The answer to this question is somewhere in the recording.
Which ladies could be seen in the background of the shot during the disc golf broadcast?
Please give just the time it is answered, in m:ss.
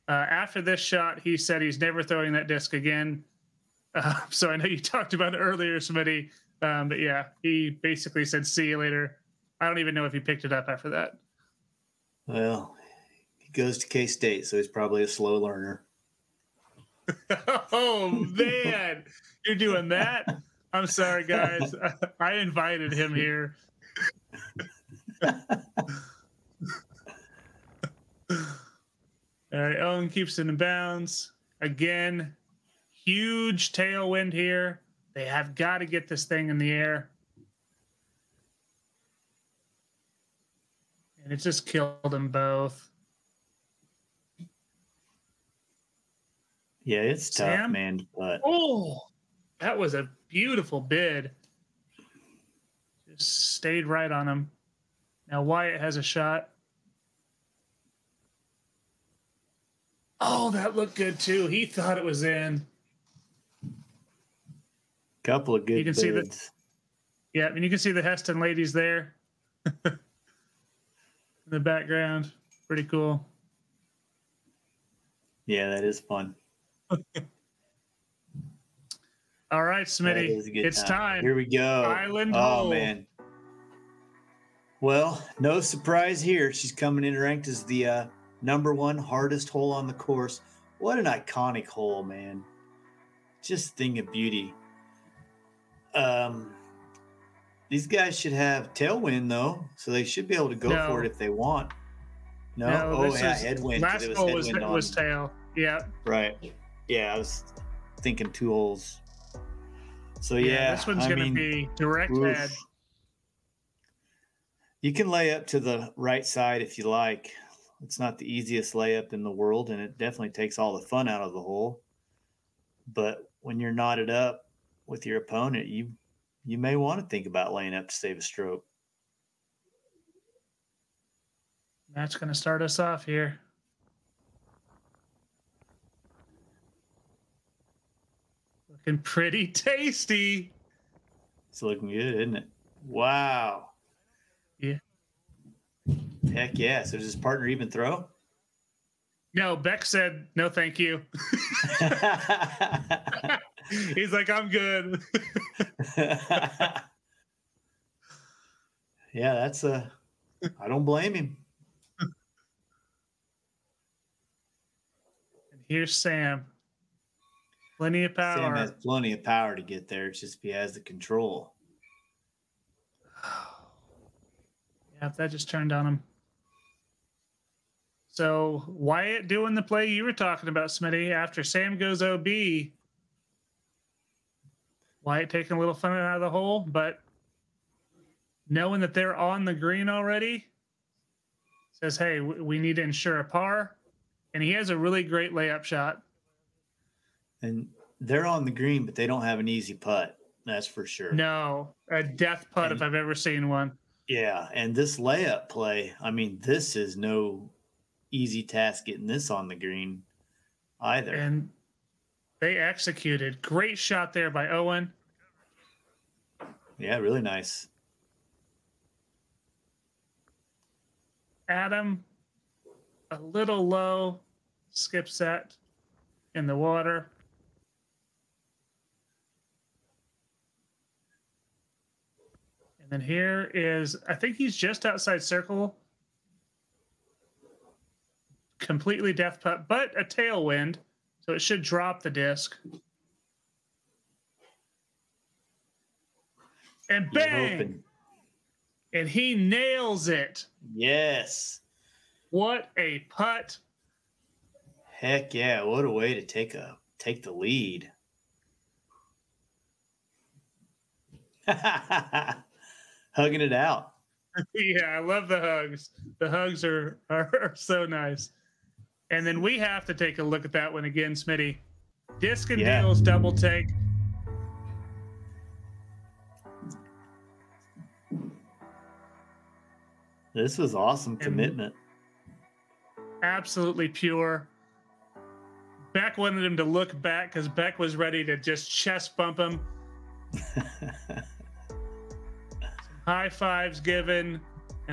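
1:08.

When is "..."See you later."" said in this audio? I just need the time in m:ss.
0:08.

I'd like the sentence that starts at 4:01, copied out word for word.
So it should drop the disc.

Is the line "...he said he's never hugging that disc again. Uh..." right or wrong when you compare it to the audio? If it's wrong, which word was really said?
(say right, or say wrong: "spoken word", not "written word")
wrong: "throwing", not "hugging".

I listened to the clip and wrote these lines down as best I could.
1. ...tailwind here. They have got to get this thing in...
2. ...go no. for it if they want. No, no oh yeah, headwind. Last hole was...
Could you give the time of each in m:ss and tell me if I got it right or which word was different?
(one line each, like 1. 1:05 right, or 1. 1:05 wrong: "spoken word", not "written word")
1. 0:33 right
2. 1:40 right.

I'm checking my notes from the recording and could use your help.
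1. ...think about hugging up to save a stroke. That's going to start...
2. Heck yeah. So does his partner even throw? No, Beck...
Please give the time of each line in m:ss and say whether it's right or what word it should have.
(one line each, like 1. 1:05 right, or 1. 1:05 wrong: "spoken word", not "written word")
1. 2:07 wrong: "laying", not "hugging"
2. 2:26 right.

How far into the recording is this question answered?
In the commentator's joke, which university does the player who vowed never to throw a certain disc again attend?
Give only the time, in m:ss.
0:13.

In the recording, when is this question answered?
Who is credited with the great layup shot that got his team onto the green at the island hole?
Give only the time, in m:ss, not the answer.
3:34.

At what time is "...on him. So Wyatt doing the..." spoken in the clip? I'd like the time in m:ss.
2:55.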